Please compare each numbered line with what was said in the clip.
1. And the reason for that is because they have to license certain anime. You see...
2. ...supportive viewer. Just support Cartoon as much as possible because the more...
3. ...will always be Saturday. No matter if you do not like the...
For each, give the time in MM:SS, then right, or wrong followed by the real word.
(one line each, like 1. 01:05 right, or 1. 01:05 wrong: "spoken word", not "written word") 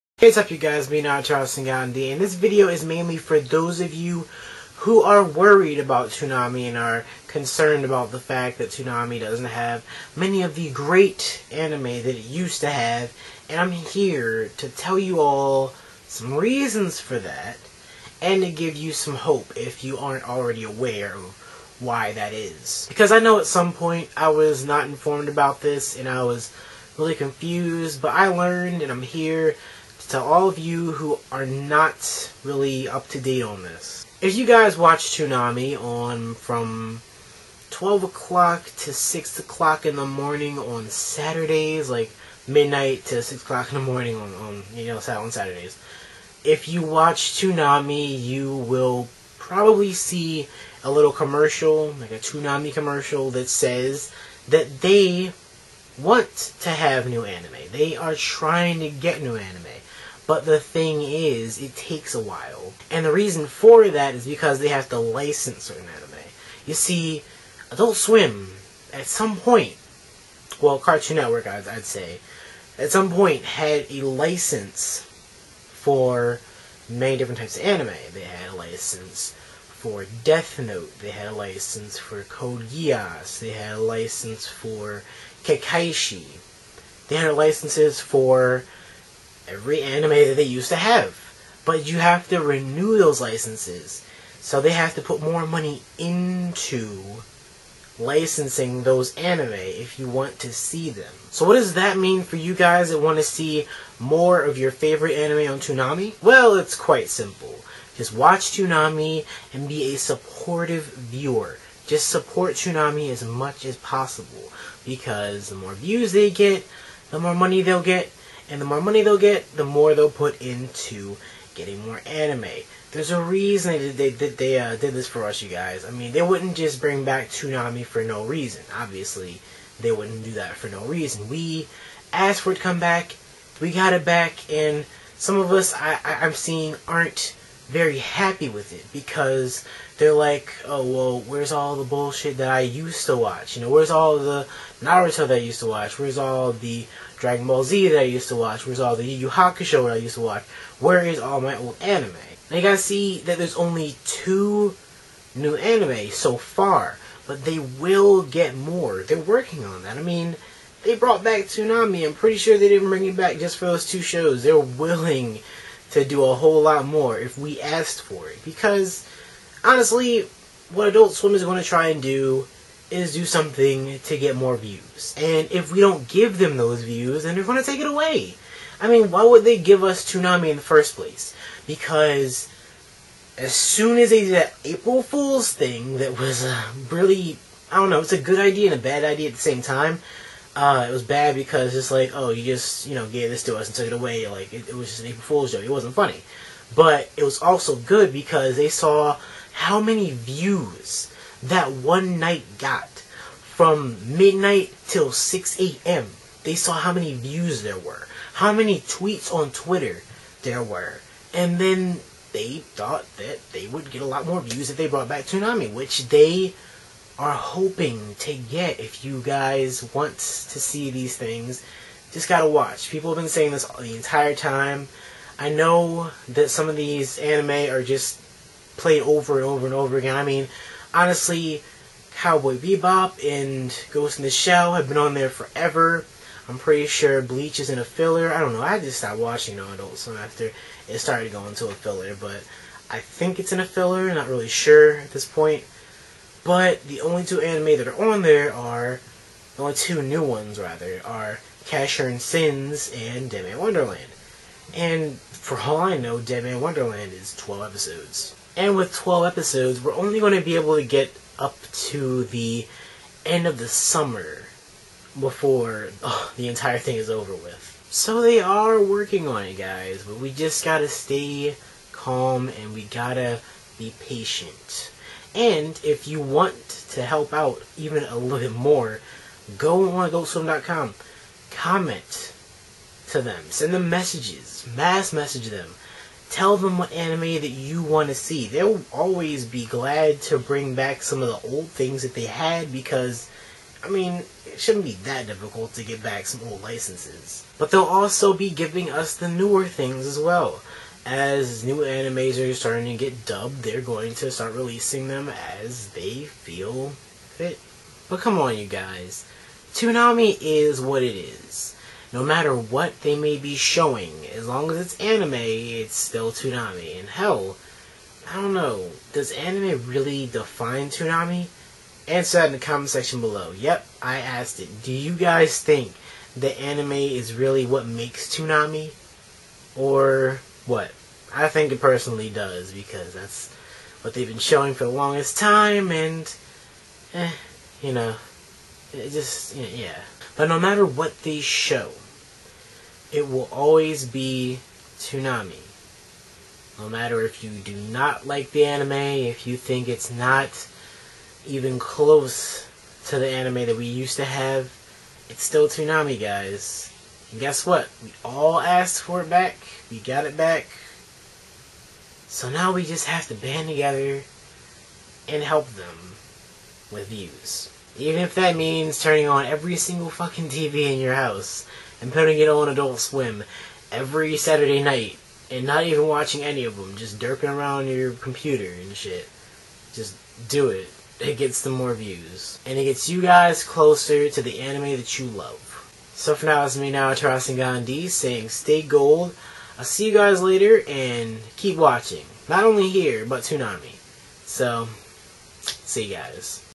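1. 01:02 right
2. 01:49 wrong: "Toonami", not "Cartoon"
3. 05:43 wrong: "Toonami", not "Saturday".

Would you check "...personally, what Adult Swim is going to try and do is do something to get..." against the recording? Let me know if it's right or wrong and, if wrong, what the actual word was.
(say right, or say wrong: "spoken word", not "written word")
wrong: "honestly", not "personally".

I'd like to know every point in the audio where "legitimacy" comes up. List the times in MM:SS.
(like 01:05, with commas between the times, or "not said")
not said.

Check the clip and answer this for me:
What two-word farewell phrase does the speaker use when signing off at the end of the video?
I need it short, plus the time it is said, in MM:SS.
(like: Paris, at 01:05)
Stay gold, at 06:28.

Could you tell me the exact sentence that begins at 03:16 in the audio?
But it was also good because they saw how many views that one night got from midnight till 6 a.m.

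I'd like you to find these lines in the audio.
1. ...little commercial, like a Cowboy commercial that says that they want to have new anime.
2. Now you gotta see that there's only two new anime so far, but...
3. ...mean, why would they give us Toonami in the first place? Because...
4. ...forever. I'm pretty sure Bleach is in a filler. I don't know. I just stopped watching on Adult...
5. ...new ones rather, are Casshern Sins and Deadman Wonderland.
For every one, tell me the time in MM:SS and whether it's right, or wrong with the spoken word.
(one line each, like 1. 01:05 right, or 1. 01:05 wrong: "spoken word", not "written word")
1. 00:50 wrong: "Toonami", not "Cowboy"
2. 02:32 right
3. 02:58 right
4. 03:55 right
5. 04:10 right.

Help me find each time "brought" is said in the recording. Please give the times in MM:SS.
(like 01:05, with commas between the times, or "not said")
02:40, 03:34.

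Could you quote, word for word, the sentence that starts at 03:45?
I know that some of these anime are just played over and over and over again.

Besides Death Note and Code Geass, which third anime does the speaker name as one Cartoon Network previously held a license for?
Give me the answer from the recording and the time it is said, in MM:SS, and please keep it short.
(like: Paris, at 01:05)
Kekkaishi, at 01:25.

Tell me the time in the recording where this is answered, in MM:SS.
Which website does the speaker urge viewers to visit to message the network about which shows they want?
04:40.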